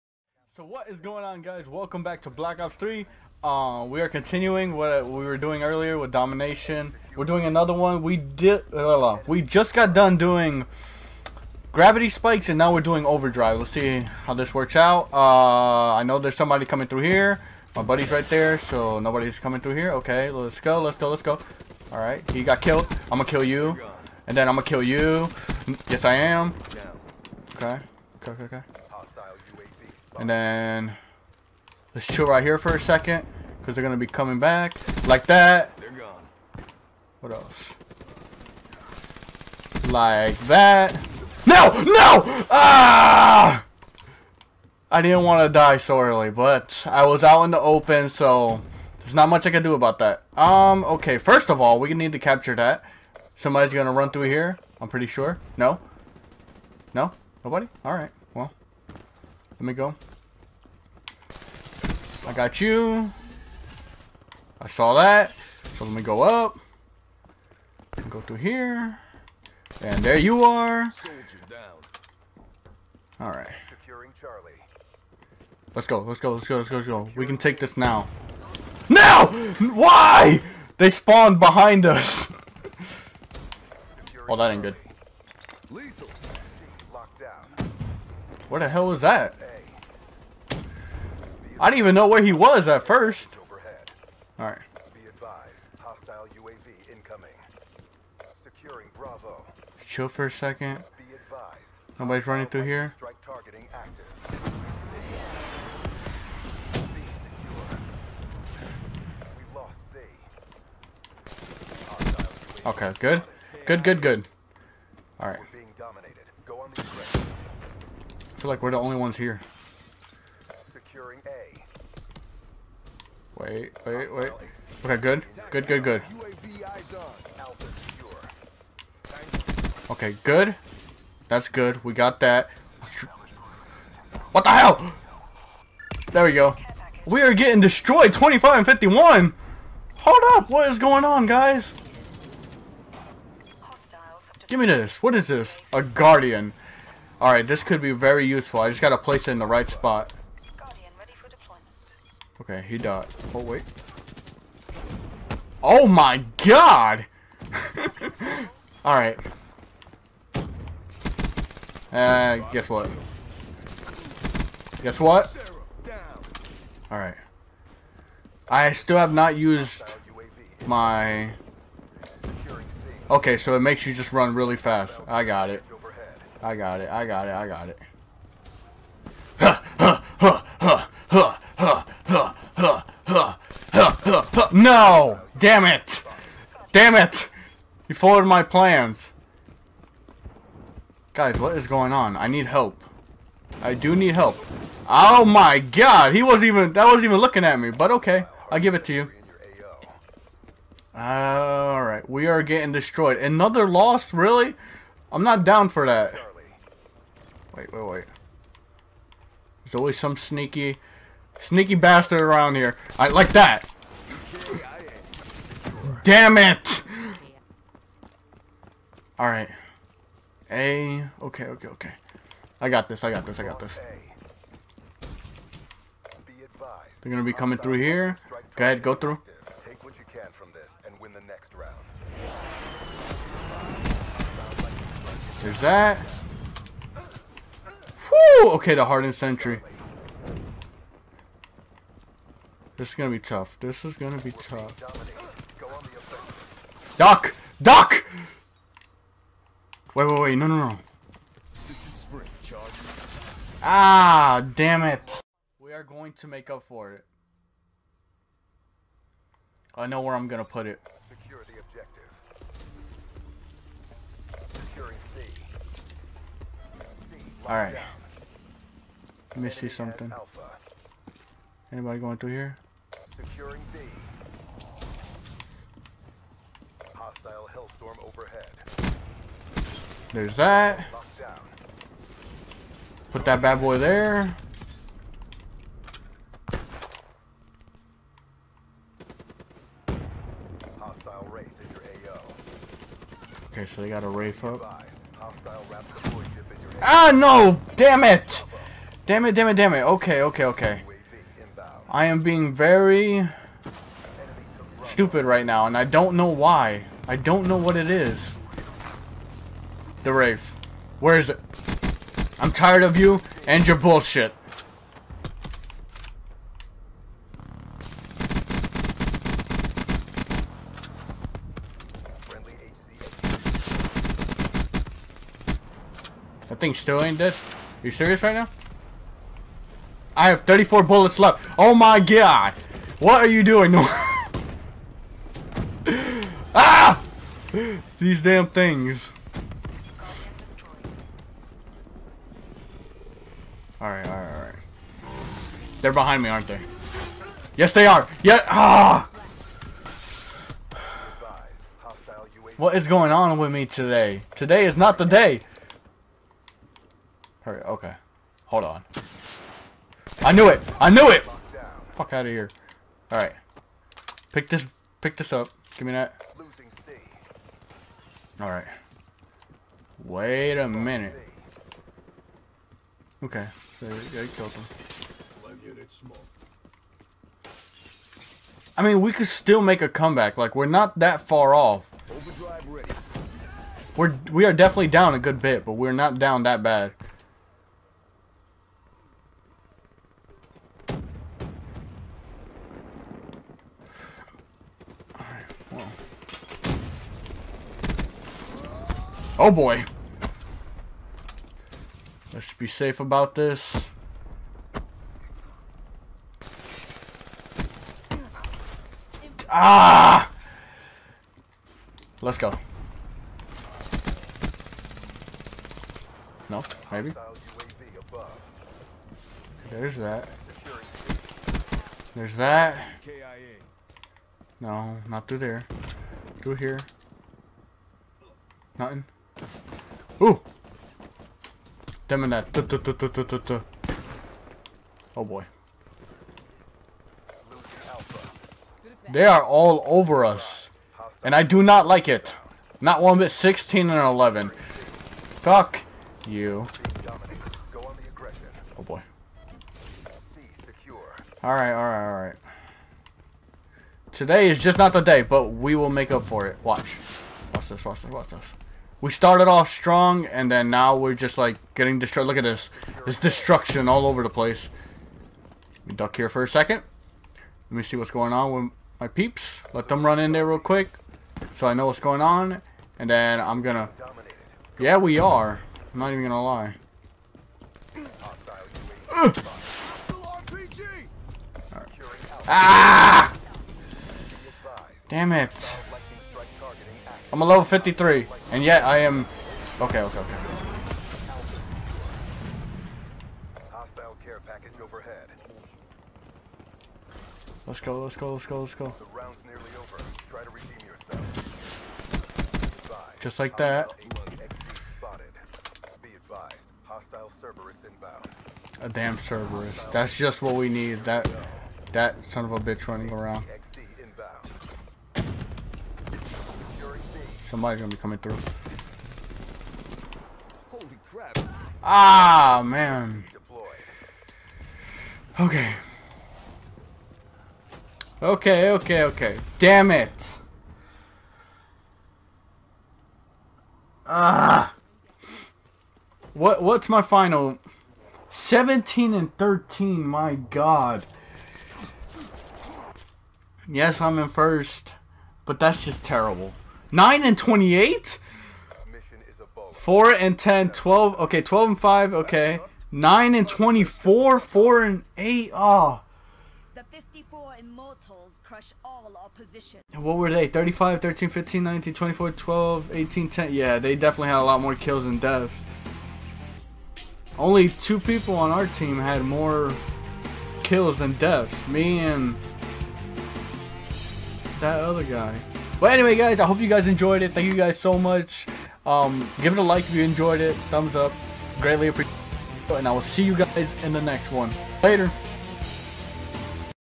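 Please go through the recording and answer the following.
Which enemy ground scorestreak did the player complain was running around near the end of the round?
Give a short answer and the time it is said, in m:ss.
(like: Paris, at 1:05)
Cerberus, at 8:29.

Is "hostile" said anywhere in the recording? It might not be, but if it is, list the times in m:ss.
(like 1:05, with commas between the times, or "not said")
1:35, 4:37, 4:50, 8:13.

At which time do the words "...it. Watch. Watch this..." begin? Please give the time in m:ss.
7:36.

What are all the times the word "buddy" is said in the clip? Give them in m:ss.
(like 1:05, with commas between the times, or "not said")
0:17.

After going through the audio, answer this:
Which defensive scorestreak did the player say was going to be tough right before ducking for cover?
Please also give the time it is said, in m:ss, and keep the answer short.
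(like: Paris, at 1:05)
Hardened sentry, at 3:58.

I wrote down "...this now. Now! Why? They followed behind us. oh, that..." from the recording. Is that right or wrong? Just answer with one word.
wrong.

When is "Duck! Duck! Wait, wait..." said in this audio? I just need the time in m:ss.
4:06.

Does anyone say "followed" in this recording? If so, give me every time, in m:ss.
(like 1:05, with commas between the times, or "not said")
3:07.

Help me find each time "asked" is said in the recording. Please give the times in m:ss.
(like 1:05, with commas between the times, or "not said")
not said.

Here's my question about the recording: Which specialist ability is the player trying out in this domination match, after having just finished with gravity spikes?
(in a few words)
Overdrive.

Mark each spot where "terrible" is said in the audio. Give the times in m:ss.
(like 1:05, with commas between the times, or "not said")
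9:06.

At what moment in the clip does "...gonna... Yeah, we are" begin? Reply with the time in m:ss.
7:53.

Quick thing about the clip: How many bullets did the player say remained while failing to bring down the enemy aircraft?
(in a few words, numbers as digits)
34.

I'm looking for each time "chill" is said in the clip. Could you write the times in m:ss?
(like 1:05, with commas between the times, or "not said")
0:32, 1:39.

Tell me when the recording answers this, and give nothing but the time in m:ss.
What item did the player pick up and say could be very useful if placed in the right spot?
2:25.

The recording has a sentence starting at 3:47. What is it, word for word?
They're gonna be coming through here.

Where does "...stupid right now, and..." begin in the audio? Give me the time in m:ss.
5:04.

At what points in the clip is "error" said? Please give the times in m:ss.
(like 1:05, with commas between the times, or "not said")
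not said.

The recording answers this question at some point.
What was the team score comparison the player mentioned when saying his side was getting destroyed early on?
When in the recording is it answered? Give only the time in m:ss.
2:18.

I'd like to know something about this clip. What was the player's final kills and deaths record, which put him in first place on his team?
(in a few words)
17 and 13.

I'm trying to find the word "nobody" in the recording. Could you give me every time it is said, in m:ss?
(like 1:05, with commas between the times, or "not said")
0:18, 0:57, 1:41.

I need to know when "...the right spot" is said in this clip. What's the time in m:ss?
2:29.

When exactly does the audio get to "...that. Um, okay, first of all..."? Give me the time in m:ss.
0:49.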